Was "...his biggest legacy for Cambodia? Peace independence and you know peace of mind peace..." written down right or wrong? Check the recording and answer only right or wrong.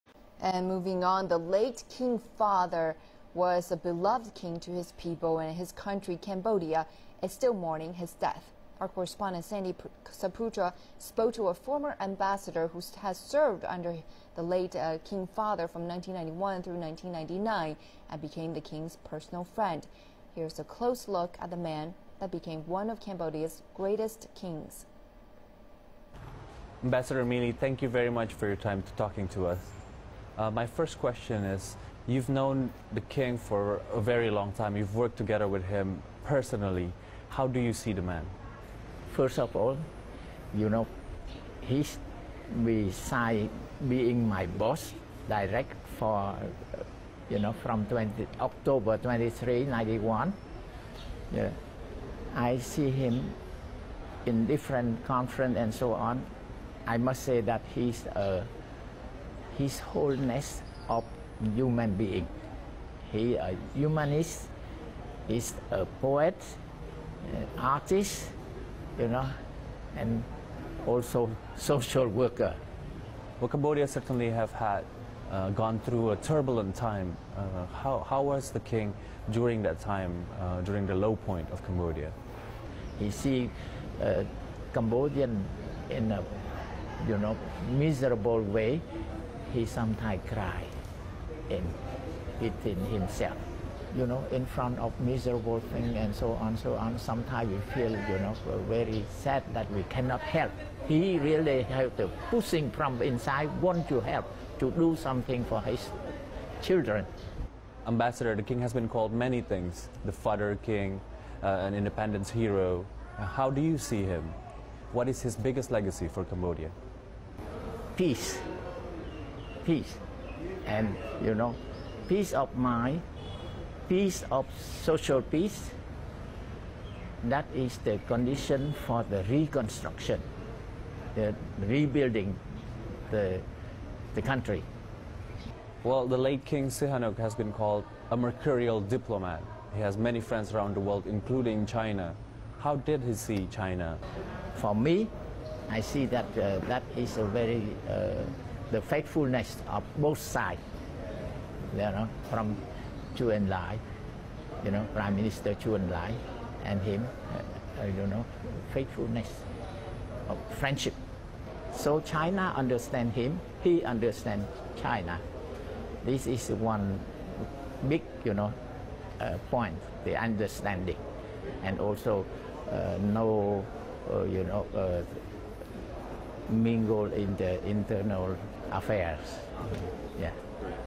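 wrong.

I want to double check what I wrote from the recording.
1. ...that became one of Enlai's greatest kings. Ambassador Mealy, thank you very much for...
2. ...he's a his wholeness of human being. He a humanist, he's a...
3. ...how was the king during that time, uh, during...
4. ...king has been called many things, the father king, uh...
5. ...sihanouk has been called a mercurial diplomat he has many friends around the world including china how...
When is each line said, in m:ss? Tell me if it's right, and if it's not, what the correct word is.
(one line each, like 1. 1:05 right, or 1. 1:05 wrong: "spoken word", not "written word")
1. 0:22 wrong: "Cambodia", not "Enlai"
2. 0:57 right
3. 1:18 right
4. 1:48 right
5. 2:16 right.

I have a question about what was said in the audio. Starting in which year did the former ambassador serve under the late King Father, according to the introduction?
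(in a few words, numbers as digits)
1991.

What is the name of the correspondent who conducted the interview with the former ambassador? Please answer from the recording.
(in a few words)
Sandy Saputra.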